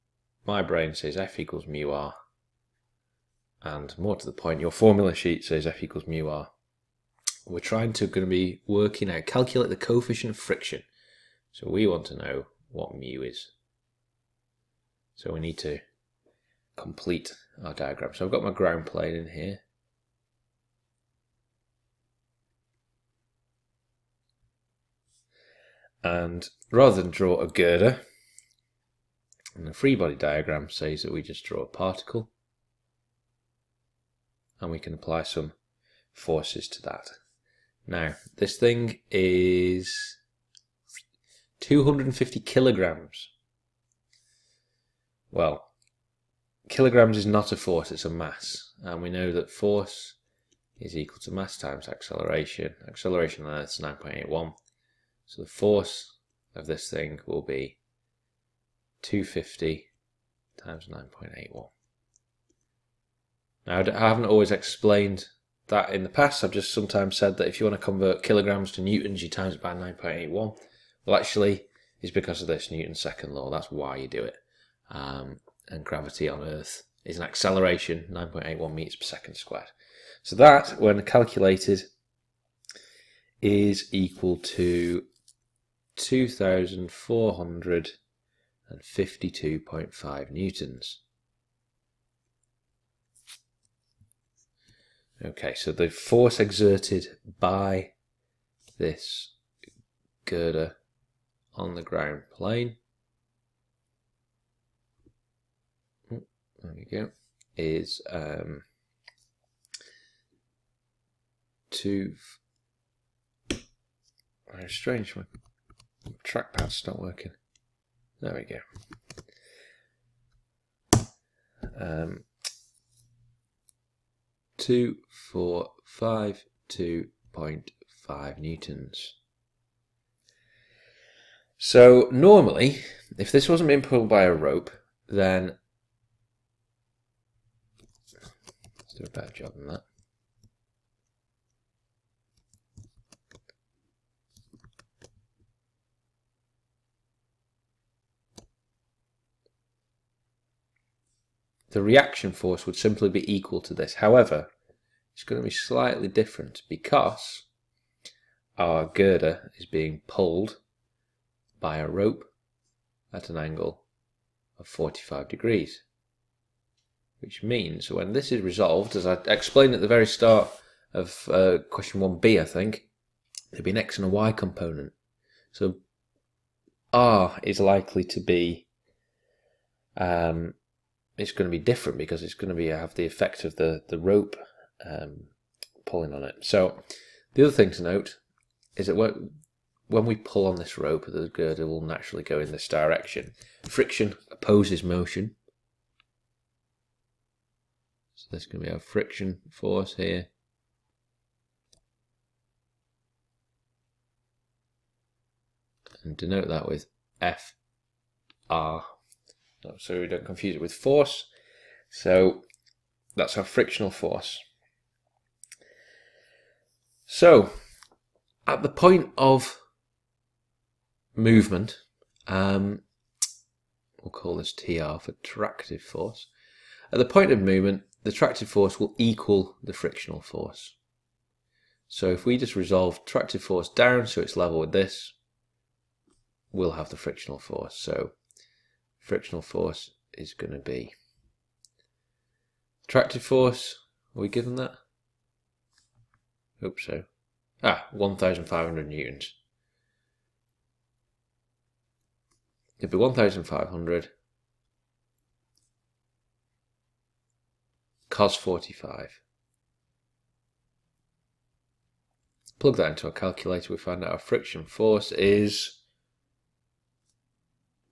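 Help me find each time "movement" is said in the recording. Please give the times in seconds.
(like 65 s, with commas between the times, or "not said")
221 s, 227 s.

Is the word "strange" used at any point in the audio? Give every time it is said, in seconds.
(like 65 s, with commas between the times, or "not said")
114 s.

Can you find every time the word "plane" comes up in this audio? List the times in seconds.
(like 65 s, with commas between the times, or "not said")
18 s, 102 s.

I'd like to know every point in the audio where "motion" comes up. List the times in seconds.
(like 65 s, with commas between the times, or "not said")
194 s.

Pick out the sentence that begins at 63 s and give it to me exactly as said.
Now, I haven't always explained that in the past.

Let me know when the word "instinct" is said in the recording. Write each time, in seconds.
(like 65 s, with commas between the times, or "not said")
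not said.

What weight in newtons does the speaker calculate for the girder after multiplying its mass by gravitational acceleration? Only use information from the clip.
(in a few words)
2,452.5 newtons.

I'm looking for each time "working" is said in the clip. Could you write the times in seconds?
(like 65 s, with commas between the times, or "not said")
8 s, 116 s.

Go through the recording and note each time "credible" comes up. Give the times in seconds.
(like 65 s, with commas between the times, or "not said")
not said.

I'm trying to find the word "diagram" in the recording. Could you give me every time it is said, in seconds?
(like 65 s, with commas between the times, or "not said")
17 s, 30 s.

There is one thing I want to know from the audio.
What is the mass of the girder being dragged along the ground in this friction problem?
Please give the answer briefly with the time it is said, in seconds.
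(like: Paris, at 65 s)
250 kilograms, at 41 s.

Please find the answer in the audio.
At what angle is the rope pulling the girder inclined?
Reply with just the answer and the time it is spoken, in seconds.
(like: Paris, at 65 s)
45 degrees, at 164 s.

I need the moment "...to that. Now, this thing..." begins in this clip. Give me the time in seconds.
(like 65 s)
36 s.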